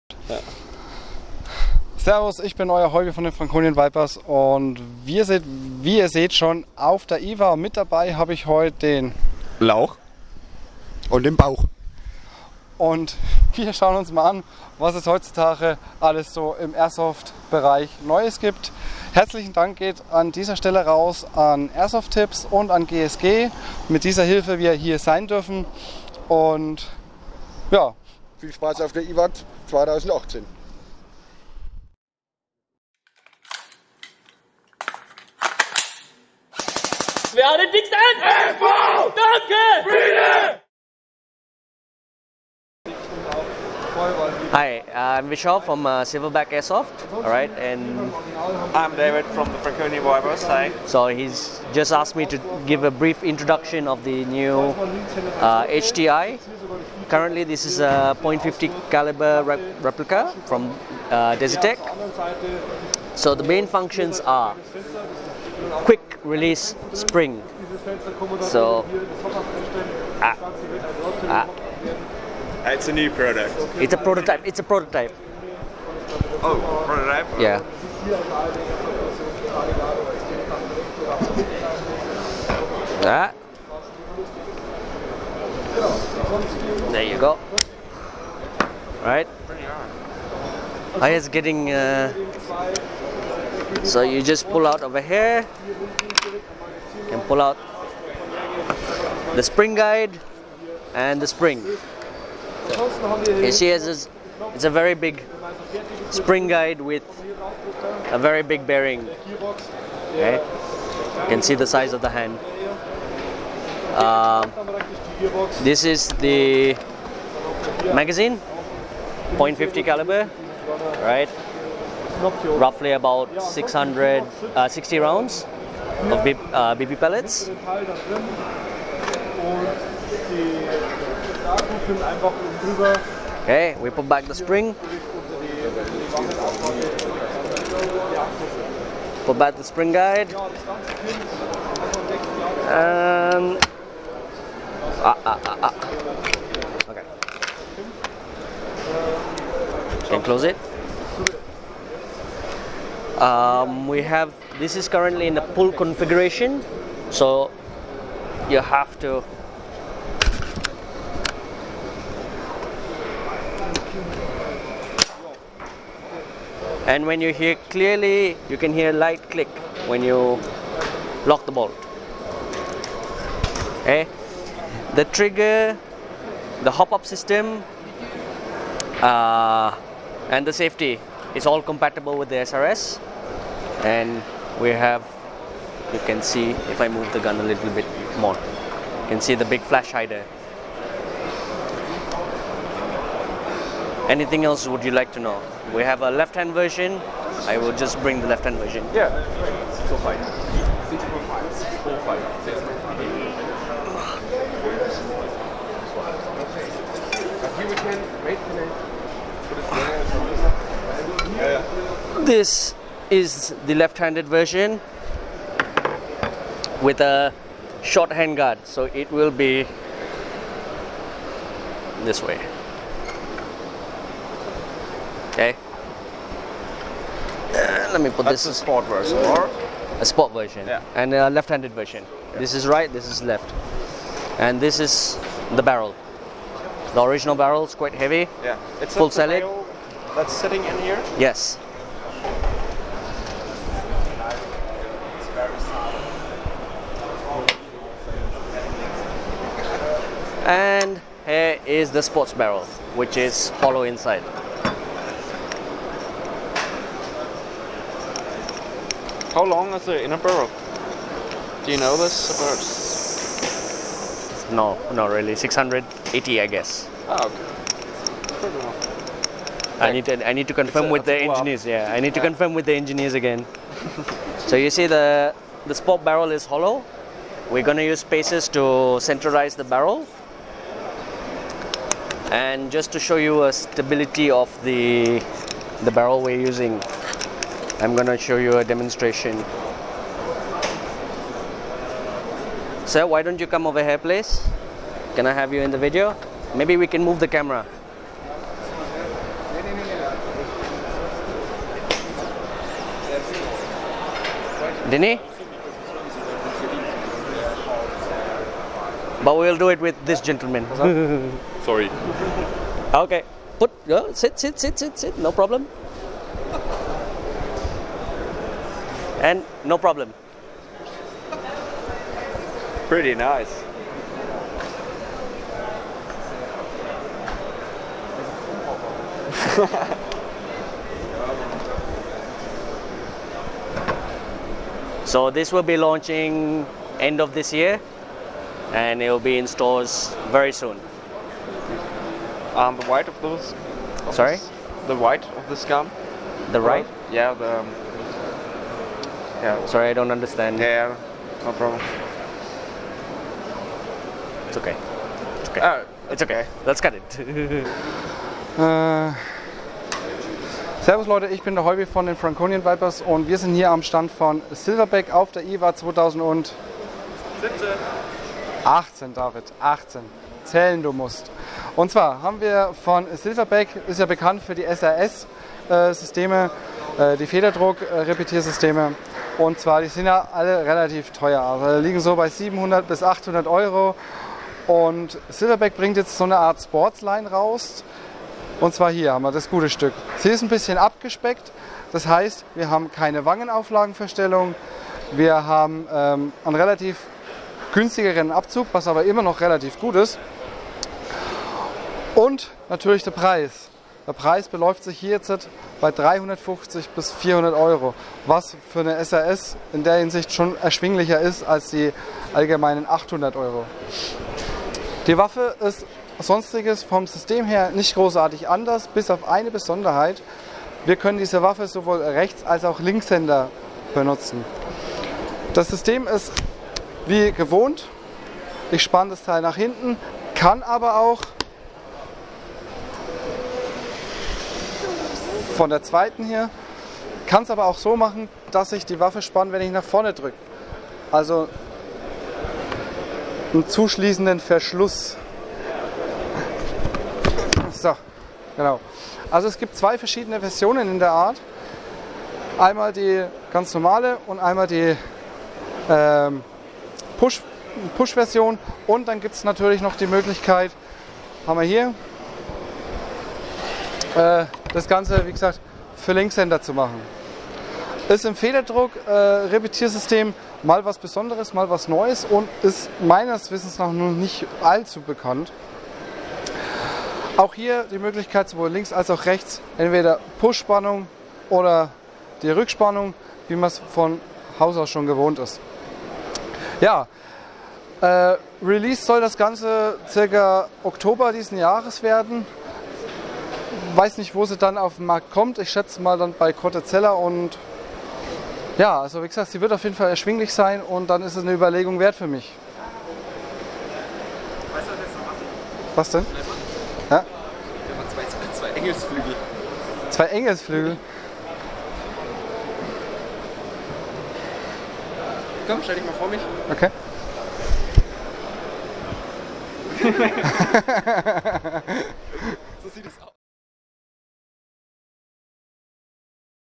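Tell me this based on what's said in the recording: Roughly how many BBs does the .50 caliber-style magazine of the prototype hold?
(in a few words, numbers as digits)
660.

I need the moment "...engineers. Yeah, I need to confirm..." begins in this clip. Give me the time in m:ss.
4:31.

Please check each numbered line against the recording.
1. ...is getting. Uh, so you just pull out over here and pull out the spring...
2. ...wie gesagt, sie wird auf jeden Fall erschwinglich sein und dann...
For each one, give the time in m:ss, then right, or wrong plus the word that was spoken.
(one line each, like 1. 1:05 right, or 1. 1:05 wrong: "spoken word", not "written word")
1. 1:31 right
2. 8:19 right.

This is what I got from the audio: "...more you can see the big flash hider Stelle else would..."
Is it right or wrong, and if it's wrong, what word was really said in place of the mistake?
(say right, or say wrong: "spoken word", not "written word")
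wrong: "Anything", not "Stelle".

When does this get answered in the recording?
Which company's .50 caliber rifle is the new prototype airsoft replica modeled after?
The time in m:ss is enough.
1:01.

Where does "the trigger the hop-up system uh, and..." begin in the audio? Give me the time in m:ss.
2:54.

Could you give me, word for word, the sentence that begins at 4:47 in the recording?
I'm gonna show you a demonstration.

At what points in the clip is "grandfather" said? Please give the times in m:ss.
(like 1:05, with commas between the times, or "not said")
not said.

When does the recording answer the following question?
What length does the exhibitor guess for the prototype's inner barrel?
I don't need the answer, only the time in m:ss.
4:25.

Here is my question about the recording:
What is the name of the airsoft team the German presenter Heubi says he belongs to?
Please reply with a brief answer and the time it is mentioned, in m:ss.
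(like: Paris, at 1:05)
Franconian Vipers, at 6:02.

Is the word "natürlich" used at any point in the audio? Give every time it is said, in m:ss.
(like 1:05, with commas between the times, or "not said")
6:42, 7:39.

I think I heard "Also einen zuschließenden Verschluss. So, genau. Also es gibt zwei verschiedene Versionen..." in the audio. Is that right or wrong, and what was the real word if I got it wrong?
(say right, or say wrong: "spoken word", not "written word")
right.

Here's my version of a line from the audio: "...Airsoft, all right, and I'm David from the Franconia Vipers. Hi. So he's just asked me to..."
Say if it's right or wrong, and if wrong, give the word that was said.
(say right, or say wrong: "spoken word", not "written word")
right.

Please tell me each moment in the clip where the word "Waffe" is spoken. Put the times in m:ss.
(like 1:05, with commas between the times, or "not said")
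6:55, 7:01, 7:18.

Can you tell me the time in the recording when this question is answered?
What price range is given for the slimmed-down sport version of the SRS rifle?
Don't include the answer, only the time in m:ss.
6:45.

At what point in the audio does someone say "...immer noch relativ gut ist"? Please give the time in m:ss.
6:39.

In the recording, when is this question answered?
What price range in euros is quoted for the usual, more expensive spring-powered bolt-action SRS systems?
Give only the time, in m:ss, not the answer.
6:22.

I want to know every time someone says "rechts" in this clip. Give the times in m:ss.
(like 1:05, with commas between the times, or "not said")
7:02, 7:59.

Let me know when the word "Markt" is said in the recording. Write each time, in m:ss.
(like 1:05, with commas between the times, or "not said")
8:15.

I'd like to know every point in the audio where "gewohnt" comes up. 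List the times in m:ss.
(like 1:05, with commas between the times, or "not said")
7:07, 8:05.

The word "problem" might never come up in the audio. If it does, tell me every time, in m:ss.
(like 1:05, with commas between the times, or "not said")
5:15, 5:19, 5:51.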